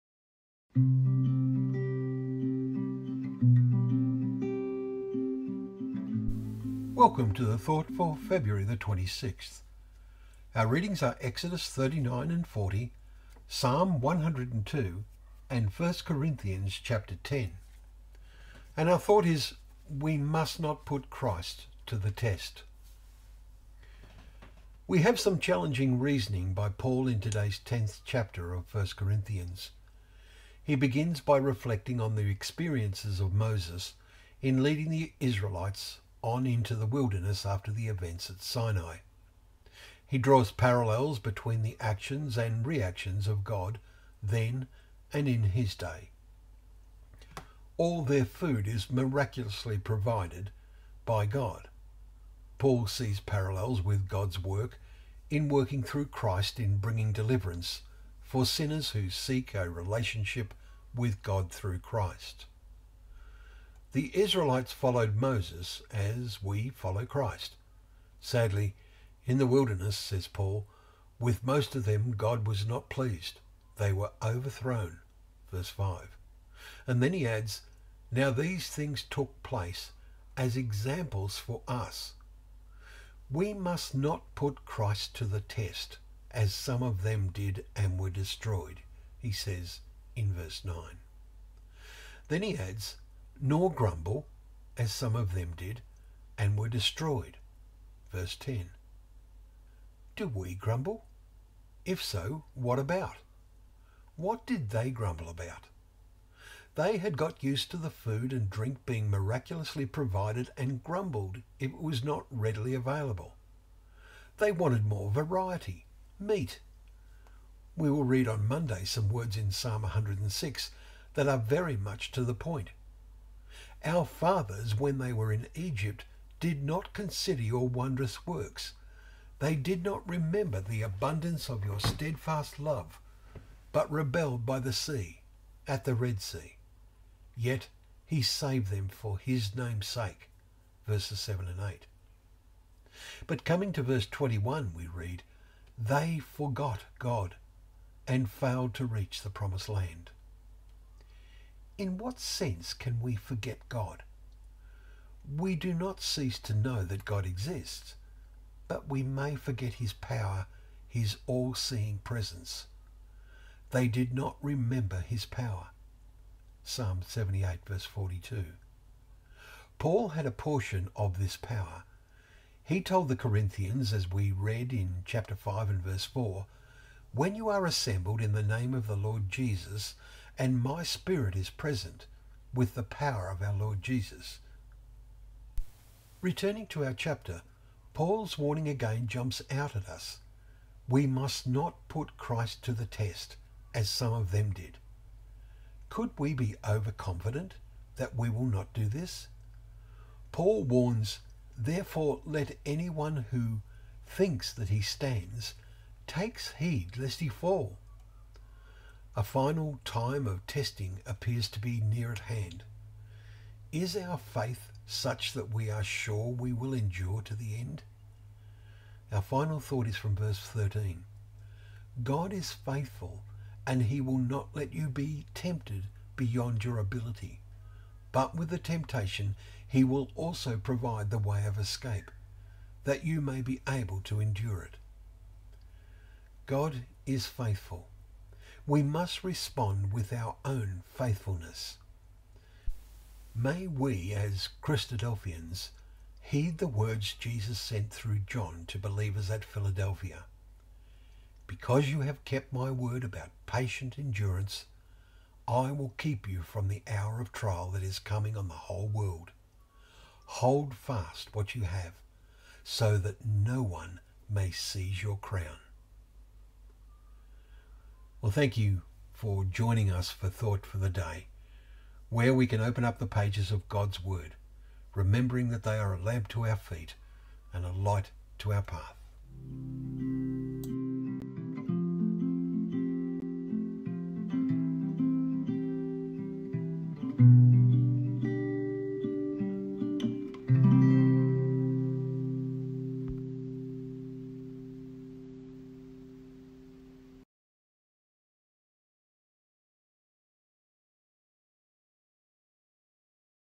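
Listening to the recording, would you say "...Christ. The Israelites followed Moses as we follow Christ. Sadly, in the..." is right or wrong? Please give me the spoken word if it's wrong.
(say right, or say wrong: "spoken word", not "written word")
right.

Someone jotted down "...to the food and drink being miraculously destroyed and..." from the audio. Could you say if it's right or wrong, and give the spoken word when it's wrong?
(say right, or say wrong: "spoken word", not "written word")
wrong: "provided", not "destroyed".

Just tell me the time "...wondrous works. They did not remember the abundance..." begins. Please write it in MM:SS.
02:07.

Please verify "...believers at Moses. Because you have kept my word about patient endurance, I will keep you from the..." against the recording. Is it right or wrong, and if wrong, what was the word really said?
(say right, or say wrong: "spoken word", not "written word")
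wrong: "Philadelphia", not "Moses".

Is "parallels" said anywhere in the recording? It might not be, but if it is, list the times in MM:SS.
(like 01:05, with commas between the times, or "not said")
00:40, 00:53.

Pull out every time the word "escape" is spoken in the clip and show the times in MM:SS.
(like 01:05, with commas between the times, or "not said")
03:51.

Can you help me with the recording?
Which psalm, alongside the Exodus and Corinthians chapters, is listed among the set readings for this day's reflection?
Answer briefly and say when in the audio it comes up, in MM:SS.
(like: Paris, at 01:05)
Psalm 102, at 00:13.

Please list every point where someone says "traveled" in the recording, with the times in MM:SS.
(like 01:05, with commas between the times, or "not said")
not said.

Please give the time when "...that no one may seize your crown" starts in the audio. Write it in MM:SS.
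04:22.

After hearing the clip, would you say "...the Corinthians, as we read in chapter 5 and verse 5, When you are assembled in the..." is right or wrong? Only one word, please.
wrong.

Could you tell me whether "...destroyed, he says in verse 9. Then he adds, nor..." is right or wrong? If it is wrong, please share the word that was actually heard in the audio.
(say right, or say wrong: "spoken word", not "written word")
right.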